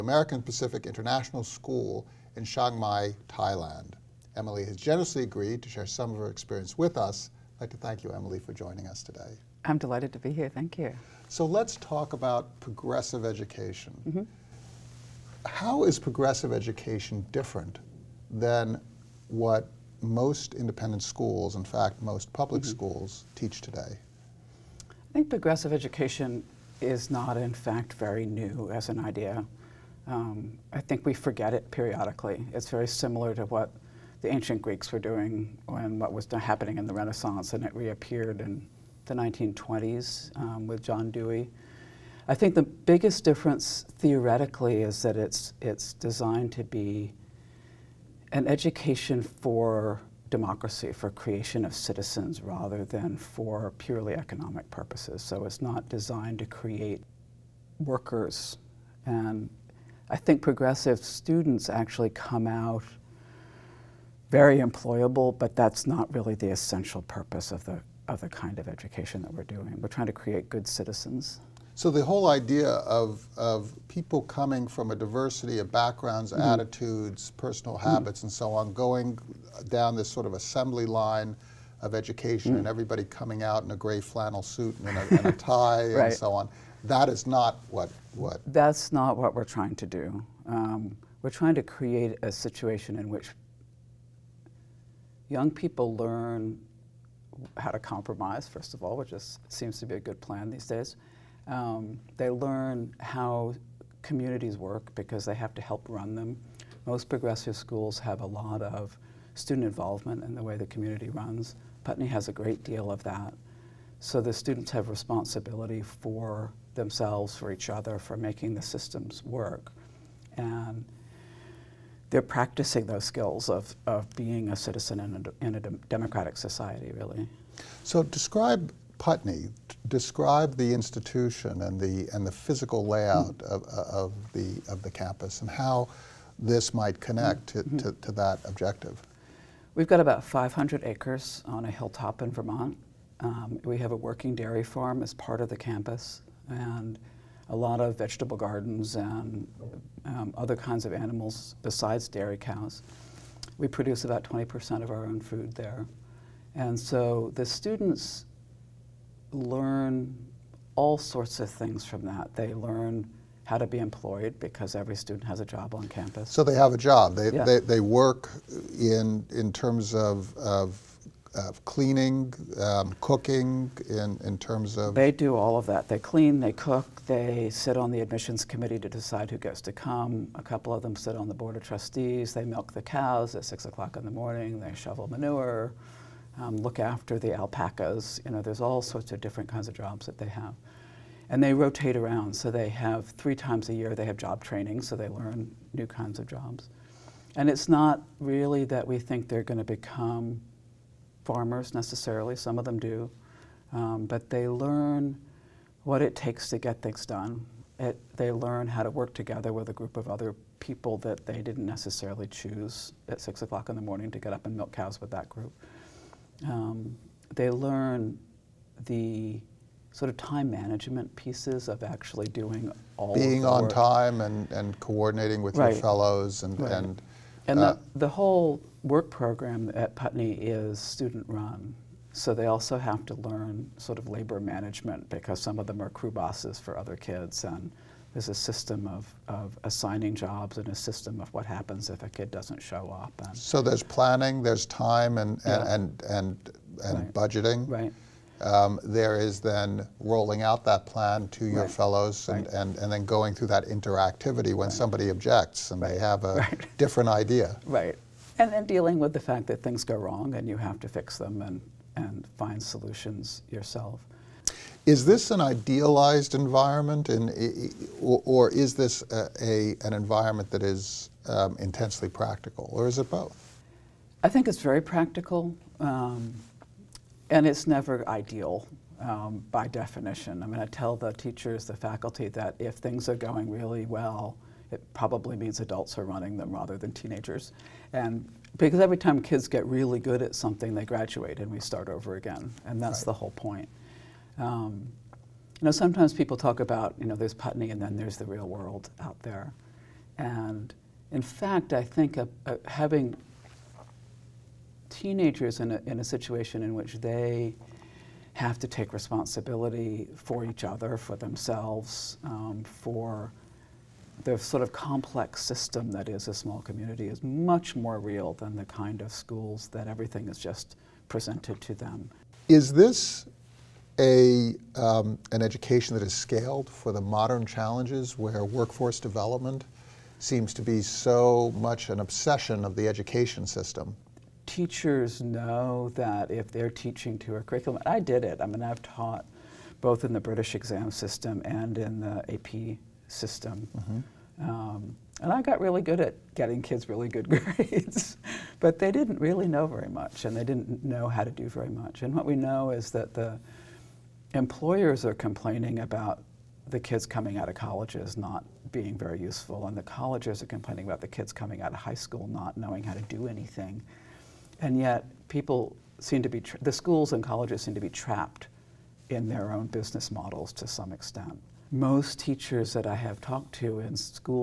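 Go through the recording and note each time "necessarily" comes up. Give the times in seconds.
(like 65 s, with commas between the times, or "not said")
201 s, 211 s.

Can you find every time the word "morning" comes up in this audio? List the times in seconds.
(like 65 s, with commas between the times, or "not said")
184 s, 213 s.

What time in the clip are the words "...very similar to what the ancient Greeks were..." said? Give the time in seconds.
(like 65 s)
32 s.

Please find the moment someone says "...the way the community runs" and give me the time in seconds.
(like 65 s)
110 s.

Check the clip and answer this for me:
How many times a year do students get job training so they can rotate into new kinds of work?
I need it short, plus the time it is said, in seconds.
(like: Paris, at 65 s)
3, at 193 s.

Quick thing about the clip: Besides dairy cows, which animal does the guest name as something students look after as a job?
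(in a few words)
alpacas.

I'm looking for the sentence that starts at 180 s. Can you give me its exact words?
A couple of them sit on the board of trustees.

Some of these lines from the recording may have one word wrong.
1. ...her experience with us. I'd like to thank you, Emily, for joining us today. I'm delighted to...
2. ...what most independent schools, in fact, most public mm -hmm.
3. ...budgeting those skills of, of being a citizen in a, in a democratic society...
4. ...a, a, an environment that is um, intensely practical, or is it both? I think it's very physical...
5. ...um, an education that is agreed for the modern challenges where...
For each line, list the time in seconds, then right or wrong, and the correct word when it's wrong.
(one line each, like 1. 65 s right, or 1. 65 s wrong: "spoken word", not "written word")
1. 6 s right
2. 19 s right
3. 122 s wrong: "practicing", not "budgeting"
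4. 269 s wrong: "practical", not "physical"
5. 324 s wrong: "scaled", not "agreed".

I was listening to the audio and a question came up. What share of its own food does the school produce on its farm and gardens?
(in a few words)
20%.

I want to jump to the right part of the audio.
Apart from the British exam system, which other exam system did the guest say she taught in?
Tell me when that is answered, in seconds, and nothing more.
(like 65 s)
342 s.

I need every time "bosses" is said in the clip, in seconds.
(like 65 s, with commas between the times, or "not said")
236 s.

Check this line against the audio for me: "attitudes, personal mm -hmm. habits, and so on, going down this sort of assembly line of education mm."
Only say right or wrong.
right.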